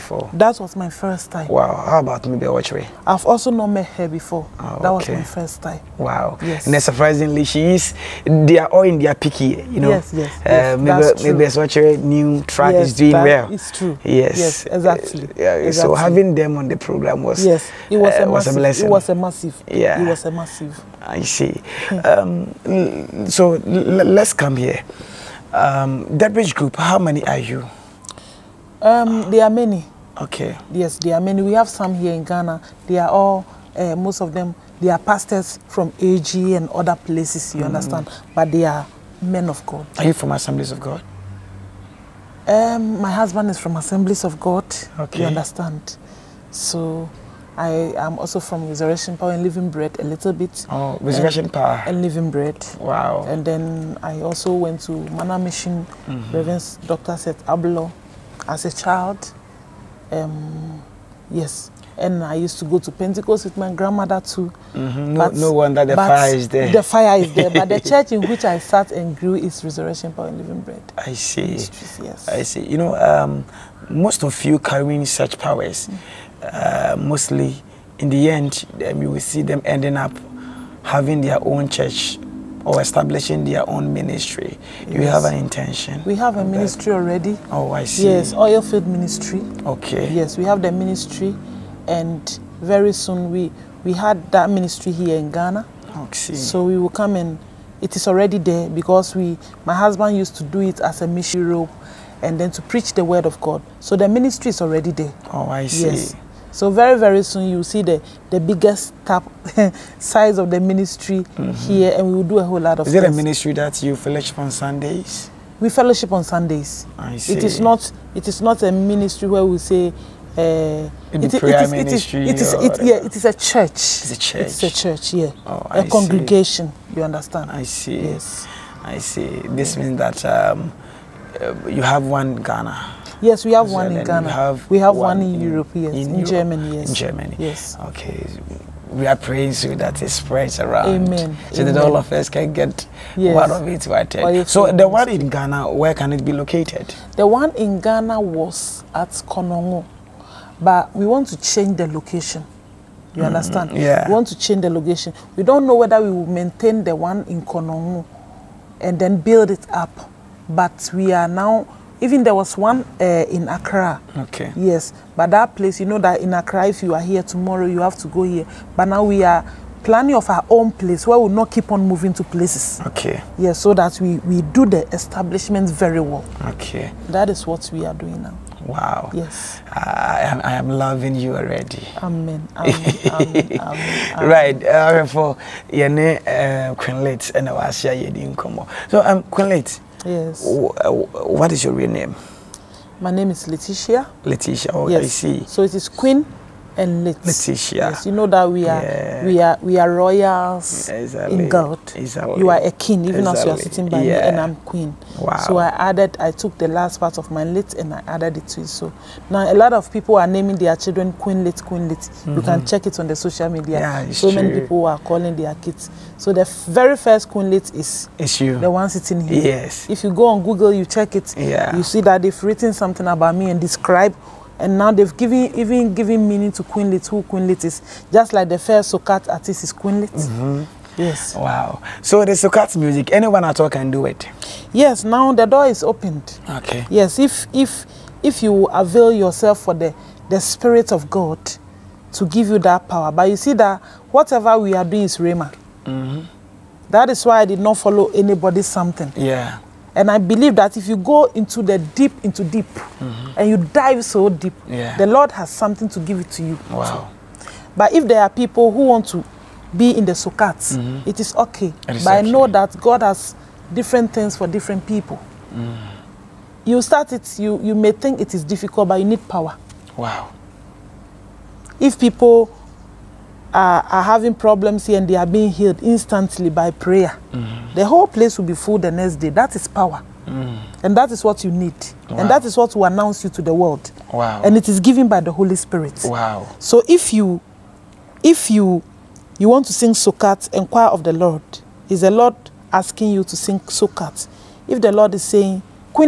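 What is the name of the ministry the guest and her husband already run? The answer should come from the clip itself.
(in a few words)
Oil Field Ministry.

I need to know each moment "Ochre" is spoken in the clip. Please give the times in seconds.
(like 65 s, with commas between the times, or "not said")
2 s, 11 s.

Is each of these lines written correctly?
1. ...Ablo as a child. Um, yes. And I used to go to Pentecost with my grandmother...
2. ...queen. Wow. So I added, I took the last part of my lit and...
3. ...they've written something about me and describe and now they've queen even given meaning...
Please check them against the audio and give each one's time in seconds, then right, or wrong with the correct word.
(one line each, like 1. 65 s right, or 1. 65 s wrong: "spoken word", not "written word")
1. 57 s right
2. 204 s right
3. 222 s wrong: "given", not "queen".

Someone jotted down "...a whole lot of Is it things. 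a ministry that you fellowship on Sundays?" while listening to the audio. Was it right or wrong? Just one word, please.
right.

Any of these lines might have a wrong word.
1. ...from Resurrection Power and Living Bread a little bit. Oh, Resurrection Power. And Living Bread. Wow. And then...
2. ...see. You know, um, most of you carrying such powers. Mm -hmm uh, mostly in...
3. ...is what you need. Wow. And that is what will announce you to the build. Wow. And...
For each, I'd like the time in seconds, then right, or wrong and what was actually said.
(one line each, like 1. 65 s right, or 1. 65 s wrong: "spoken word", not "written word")
1. 48 s right
2. 72 s right
3. 281 s wrong: "world", not "build".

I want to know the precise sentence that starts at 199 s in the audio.
we are we are royals exactly.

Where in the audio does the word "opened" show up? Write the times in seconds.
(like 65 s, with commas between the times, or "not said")
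235 s.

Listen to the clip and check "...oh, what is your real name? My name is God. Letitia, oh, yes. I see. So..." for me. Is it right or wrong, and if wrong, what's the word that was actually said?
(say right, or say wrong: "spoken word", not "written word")
wrong: "Letitia", not "God".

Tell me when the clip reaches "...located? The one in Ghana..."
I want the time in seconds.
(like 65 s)
146 s.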